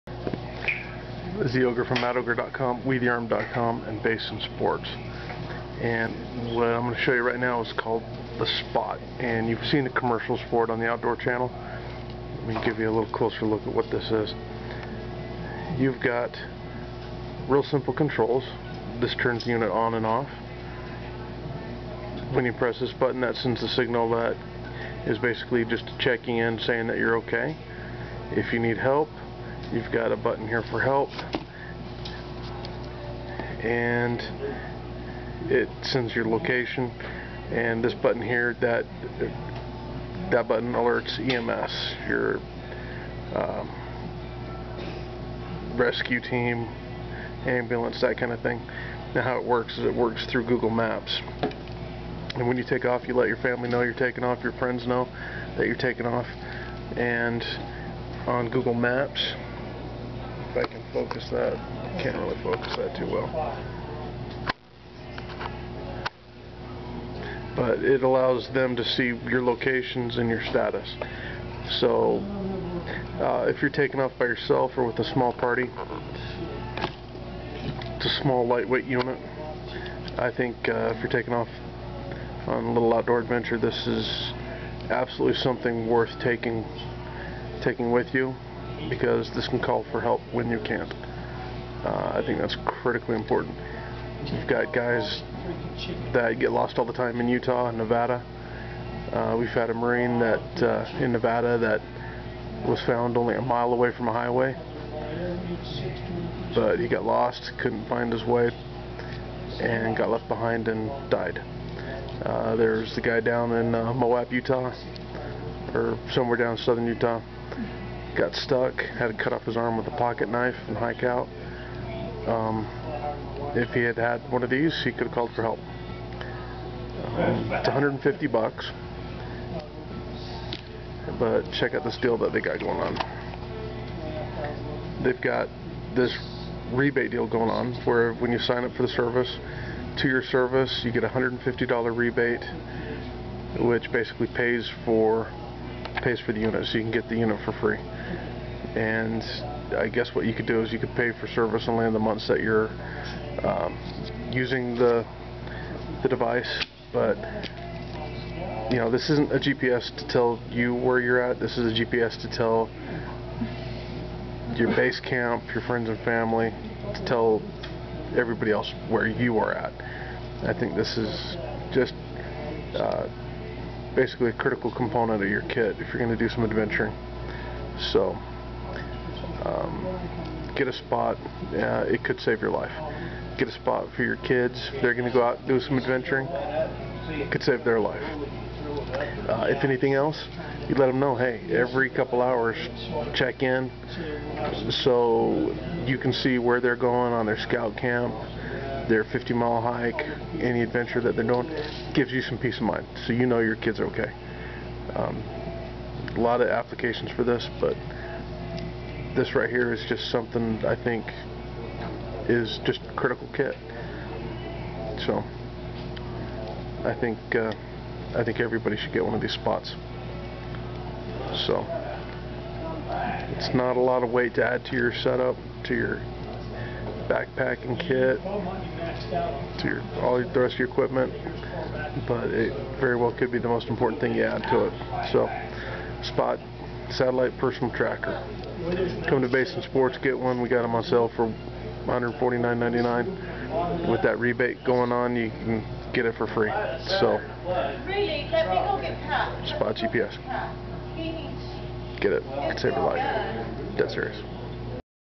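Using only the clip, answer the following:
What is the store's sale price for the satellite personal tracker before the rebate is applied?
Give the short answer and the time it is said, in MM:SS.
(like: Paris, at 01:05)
$149.99, at 04:01.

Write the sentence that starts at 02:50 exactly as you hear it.
I think this is just uh, basically a critical component of your kit if you're going to do some adventuring.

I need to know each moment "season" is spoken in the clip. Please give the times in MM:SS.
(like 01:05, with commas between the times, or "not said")
not said.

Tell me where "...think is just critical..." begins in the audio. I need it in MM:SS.
03:30.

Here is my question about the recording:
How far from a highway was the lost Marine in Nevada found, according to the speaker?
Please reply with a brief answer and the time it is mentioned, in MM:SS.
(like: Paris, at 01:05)
a mile, at 01:43.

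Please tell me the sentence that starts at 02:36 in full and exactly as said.
But you know, this isn't a GPS to tell you where you're at.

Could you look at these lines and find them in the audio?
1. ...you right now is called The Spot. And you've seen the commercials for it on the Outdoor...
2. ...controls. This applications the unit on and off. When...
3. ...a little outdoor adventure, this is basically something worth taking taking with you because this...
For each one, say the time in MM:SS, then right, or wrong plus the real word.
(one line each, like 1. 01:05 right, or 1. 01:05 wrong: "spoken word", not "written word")
1. 00:07 right
2. 00:17 wrong: "turns", not "applications"
3. 01:22 wrong: "absolutely", not "basically".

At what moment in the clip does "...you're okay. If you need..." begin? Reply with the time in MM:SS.
00:26.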